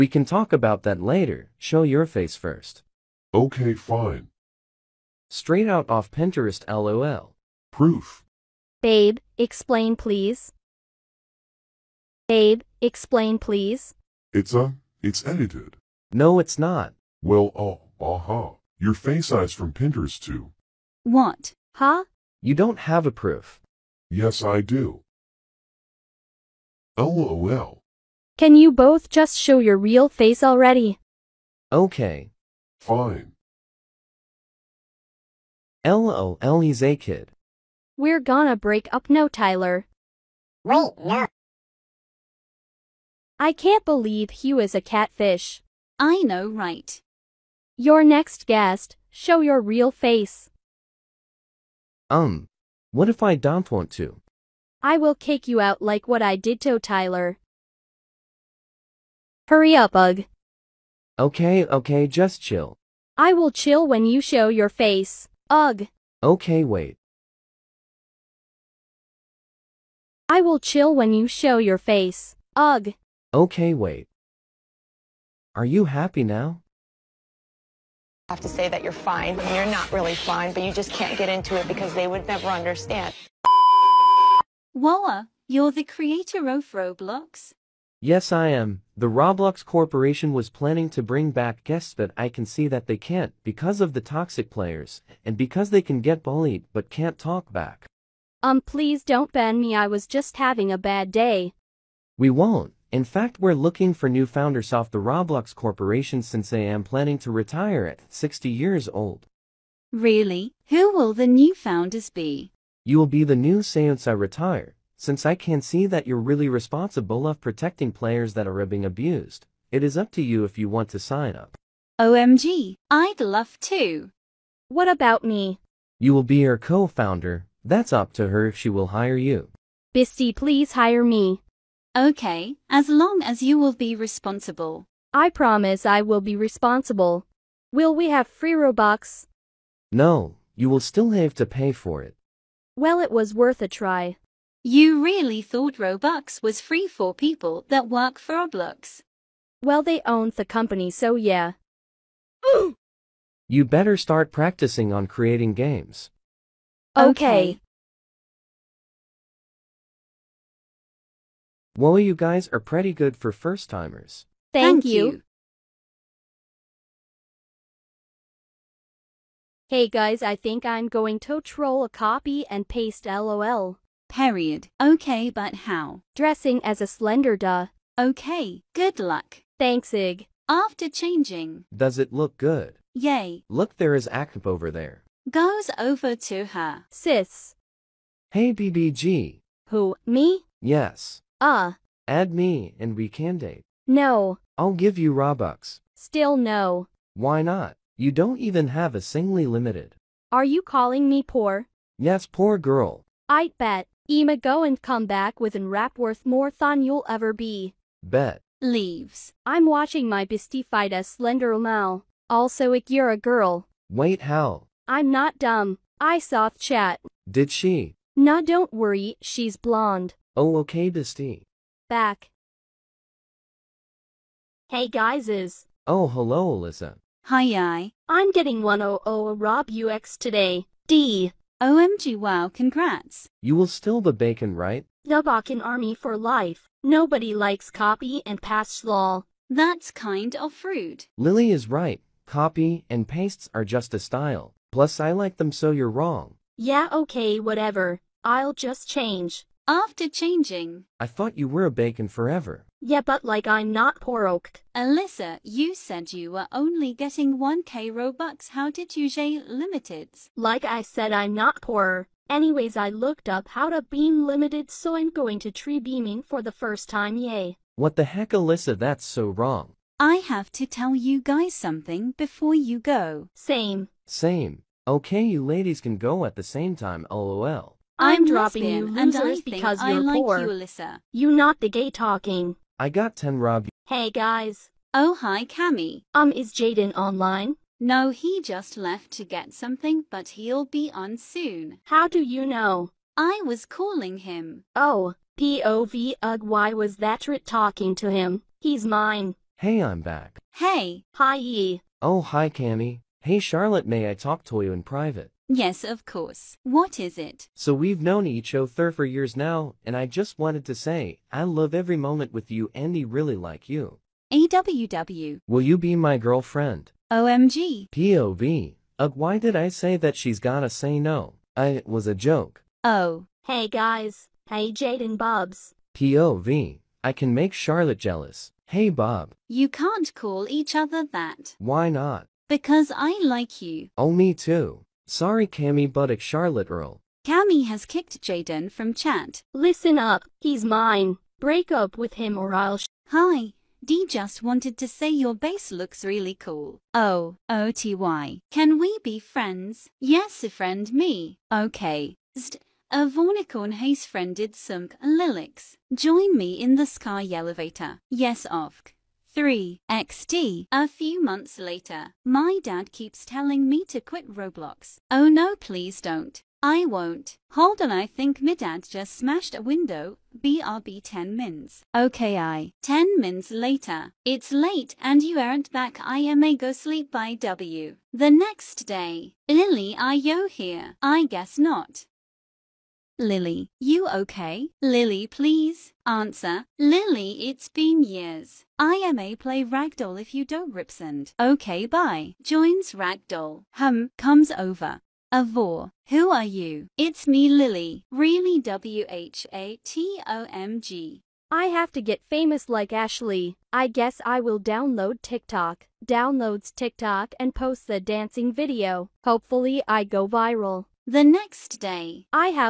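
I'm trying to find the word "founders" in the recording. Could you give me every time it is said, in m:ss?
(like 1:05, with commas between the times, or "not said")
1:44, 1:51, 2:06.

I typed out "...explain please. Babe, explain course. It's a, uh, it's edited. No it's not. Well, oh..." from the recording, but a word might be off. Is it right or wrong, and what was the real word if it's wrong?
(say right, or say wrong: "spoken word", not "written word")
wrong: "please", not "course".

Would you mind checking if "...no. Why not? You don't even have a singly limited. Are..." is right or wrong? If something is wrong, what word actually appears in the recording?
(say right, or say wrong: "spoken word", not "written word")
right.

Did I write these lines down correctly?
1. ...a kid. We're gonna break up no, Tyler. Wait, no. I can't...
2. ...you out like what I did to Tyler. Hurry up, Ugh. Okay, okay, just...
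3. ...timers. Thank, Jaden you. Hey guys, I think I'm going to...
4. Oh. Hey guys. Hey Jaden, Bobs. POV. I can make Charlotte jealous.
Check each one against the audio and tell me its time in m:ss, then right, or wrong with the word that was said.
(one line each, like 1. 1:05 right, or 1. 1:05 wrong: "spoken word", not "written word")
1. 0:36 right
2. 0:55 right
3. 2:43 wrong: "Thank", not "Jaden"
4. 5:22 right.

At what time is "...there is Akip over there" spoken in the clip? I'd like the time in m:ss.
3:03.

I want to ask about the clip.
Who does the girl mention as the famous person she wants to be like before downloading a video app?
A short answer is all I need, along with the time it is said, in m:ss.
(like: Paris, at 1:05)
Ashley, at 6:42.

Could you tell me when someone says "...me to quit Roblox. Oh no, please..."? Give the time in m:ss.
6:03.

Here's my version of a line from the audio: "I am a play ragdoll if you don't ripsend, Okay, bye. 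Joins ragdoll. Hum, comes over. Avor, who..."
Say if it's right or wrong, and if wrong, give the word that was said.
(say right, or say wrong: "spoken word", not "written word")
right.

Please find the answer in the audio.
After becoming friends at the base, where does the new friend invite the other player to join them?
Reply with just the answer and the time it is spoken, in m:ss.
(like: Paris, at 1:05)
Sky elevator, at 5:56.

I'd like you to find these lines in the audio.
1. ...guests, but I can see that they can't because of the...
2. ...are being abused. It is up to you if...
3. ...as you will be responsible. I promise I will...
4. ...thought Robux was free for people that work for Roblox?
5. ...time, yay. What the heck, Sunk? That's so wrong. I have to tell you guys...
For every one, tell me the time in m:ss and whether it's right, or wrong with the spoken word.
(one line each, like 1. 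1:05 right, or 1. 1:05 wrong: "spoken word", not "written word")
1. 1:31 right
2. 1:58 right
3. 2:13 right
4. 2:25 right
5. 4:26 wrong: "Alyssa", not "Sunk".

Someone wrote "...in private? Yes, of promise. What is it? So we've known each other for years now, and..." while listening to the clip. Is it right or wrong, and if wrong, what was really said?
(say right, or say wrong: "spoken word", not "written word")
wrong: "course", not "promise".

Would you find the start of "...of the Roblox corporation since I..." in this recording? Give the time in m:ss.
1:44.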